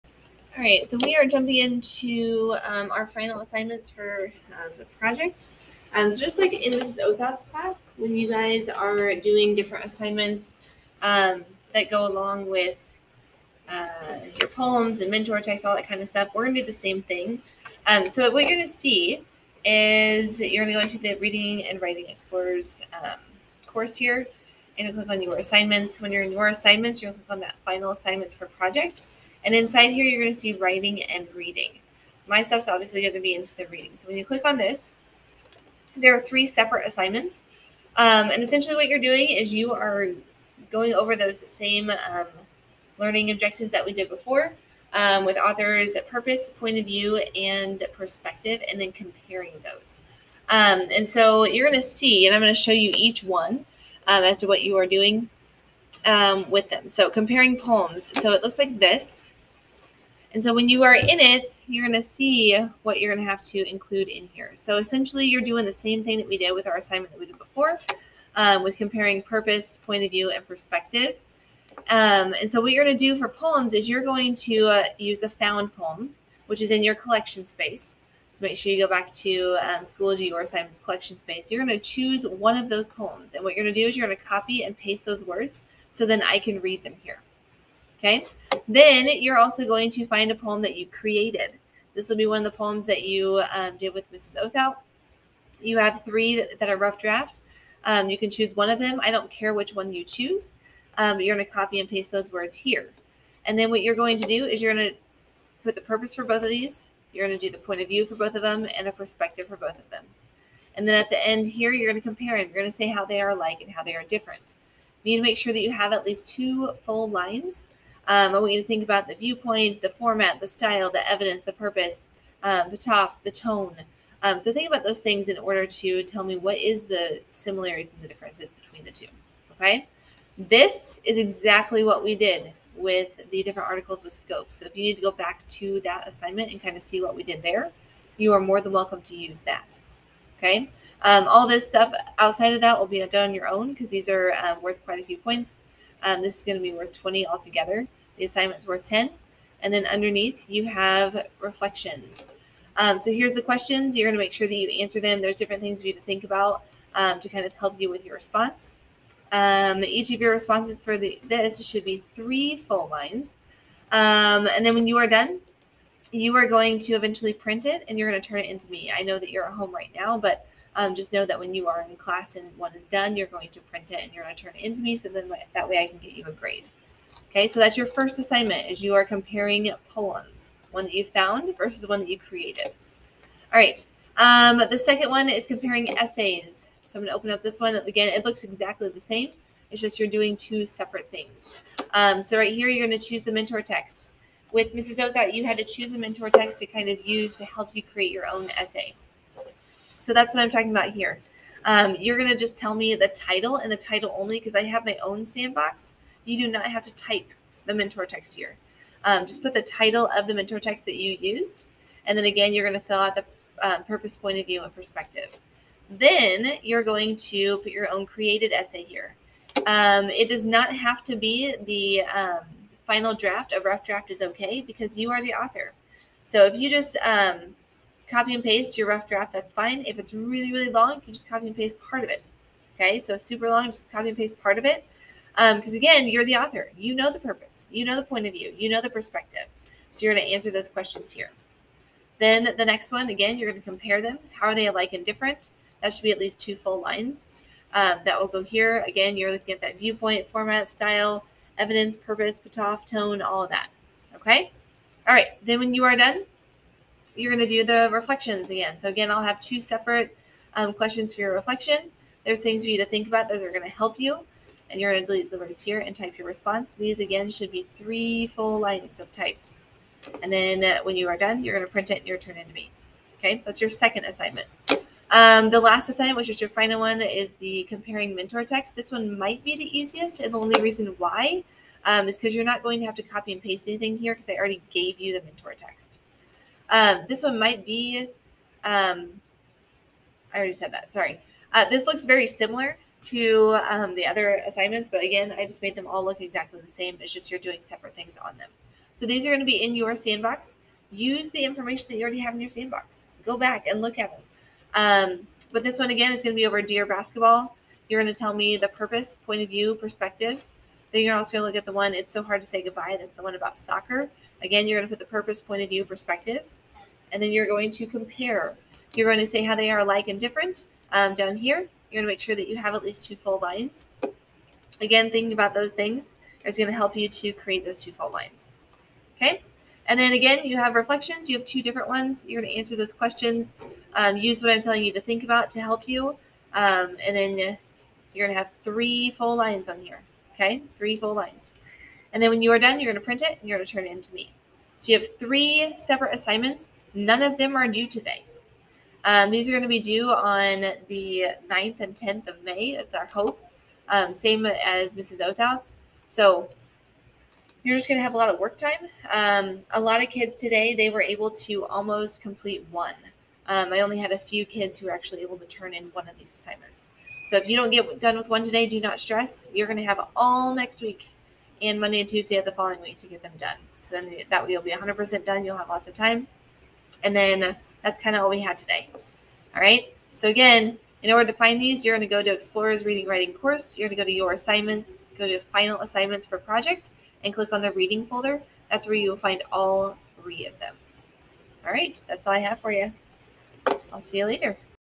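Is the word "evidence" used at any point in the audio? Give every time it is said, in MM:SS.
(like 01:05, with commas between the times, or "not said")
02:01, 04:11.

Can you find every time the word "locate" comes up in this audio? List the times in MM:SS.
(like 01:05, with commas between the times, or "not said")
not said.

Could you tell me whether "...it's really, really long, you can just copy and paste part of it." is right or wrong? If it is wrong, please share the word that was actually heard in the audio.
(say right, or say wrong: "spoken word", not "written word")
right.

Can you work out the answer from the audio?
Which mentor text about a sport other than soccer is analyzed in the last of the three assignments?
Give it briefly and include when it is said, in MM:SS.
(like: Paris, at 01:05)
Dear Basketball, at 05:06.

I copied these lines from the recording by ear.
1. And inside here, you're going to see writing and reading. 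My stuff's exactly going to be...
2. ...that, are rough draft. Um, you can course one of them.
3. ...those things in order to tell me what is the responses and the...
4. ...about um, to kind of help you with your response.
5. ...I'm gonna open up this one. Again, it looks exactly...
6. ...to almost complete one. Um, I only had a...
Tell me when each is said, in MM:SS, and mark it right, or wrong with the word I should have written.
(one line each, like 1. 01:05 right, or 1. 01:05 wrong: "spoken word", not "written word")
1. 00:29 wrong: "obviously", not "exactly"
2. 01:36 wrong: "choose", not "course"
3. 02:04 wrong: "similarities", not "responses"
4. 02:36 right
5. 03:06 right
6. 06:01 right.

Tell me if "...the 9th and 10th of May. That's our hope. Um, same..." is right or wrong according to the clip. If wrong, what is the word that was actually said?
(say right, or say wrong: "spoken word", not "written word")
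right.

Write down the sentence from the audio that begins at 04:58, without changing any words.
So these are going to be in your sandbox.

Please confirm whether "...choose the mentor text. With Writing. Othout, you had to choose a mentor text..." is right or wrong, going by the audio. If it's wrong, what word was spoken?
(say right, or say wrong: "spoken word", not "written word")
wrong: "Mrs", not "Writing".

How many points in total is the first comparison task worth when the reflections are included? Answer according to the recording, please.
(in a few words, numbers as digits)
20.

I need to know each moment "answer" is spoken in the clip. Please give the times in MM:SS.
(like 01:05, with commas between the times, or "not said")
02:34, 04:00, 05:32.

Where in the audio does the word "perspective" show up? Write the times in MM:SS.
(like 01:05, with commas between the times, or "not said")
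00:47, 01:10, 01:48, 03:34, 03:58, 05:09, 05:15.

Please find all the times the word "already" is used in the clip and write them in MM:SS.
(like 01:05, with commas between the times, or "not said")
04:44, 04:50, 05:02.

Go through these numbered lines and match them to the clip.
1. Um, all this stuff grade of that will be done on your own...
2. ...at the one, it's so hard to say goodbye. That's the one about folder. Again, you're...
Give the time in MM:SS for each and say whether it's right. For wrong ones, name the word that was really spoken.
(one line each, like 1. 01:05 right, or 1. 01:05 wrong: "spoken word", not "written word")
1. 02:21 wrong: "outside", not "grade"
2. 05:11 wrong: "soccer", not "folder".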